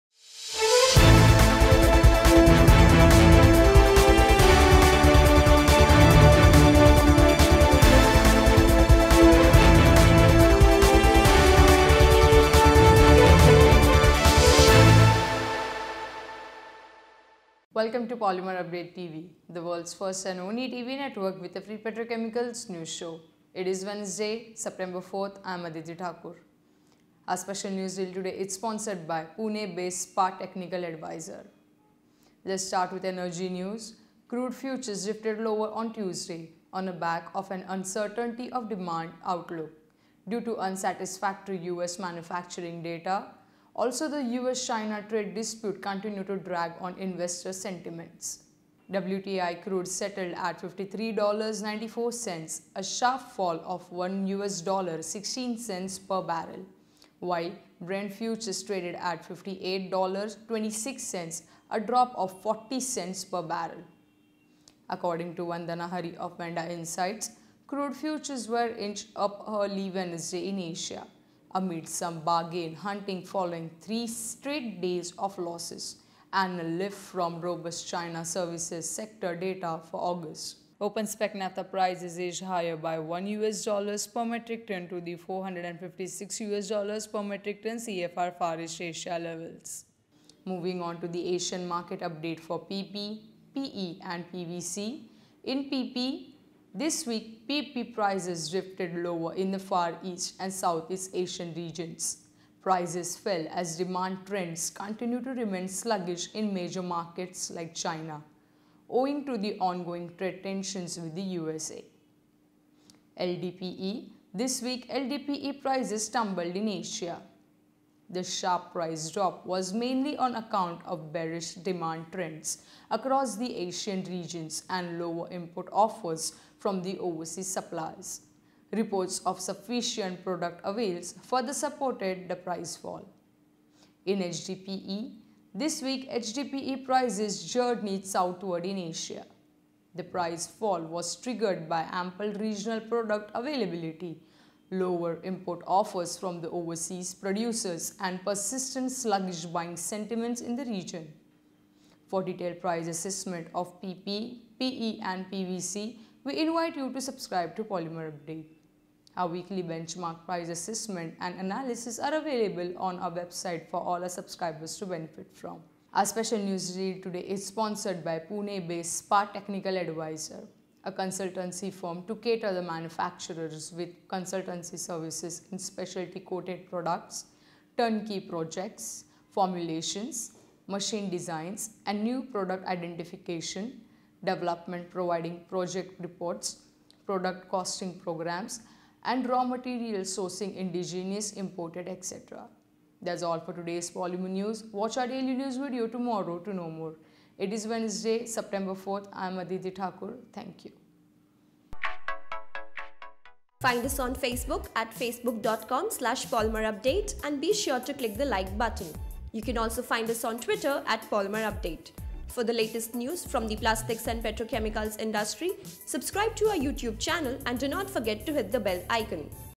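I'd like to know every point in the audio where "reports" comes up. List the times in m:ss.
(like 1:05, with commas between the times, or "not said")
2:08, 3:05.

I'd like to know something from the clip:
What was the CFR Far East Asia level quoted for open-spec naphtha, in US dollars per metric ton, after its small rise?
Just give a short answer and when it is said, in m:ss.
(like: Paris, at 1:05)
456, at 1:25.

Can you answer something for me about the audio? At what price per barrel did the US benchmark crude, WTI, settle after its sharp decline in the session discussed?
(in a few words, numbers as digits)
$53.94.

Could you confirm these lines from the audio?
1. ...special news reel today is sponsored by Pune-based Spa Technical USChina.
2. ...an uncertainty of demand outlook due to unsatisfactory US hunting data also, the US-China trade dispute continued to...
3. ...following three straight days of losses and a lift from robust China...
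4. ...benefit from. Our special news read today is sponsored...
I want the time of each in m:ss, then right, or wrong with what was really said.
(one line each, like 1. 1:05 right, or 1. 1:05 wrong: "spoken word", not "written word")
1. 0:27 wrong: "Advisor", not "USChina"
2. 0:37 wrong: "manufacturing", not "hunting"
3. 1:13 right
4. 2:44 right.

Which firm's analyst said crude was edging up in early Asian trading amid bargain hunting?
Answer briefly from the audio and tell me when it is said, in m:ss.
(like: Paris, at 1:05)
Vanda Insights, at 1:06.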